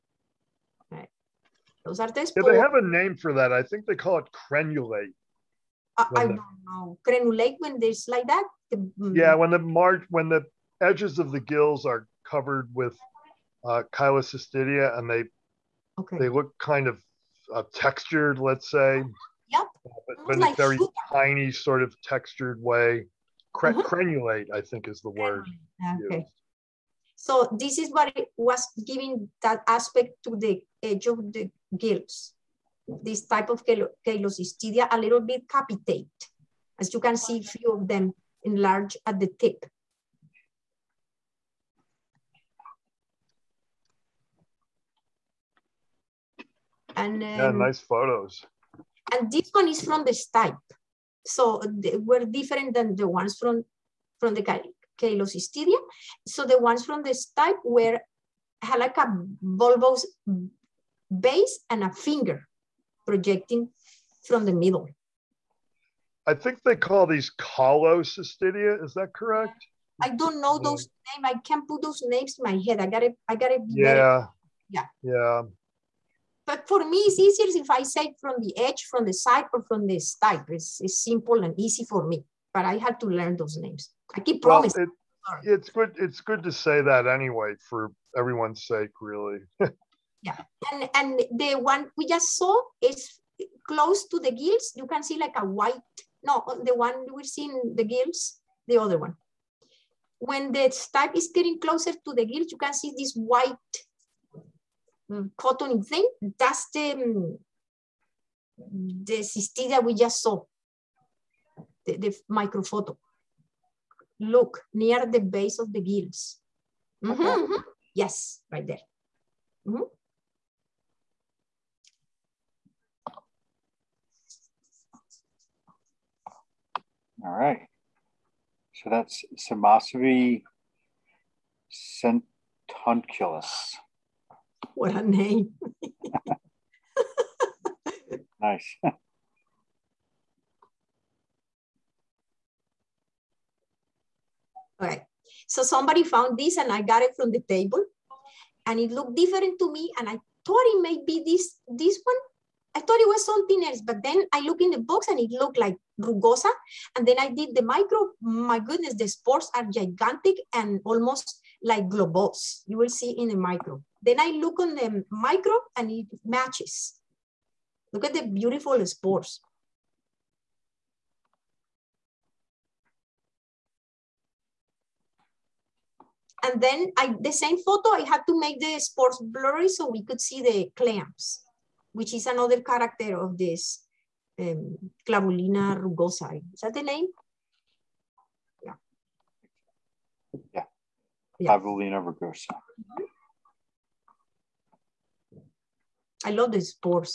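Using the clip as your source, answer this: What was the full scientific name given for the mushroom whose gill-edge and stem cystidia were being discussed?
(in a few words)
Simocybe centunculus.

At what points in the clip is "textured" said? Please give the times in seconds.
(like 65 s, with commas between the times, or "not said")
17 s, 22 s.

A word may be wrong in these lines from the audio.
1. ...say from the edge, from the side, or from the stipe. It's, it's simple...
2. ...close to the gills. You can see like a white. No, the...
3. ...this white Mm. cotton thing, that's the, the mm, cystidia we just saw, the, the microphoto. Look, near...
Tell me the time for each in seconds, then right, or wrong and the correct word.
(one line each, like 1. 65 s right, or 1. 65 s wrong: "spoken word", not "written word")
1. 77 s right
2. 93 s right
3. 102 s right.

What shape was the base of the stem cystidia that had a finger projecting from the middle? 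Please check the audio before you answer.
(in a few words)
Bulbous.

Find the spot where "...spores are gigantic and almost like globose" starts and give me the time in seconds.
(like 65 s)
159 s.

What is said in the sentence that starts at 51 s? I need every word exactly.
So they were different than the ones from, from the Calocistidia.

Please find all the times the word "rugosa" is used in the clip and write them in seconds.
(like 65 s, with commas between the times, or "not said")
155 s, 185 s, 191 s.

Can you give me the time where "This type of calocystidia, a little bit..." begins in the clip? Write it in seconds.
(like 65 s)
32 s.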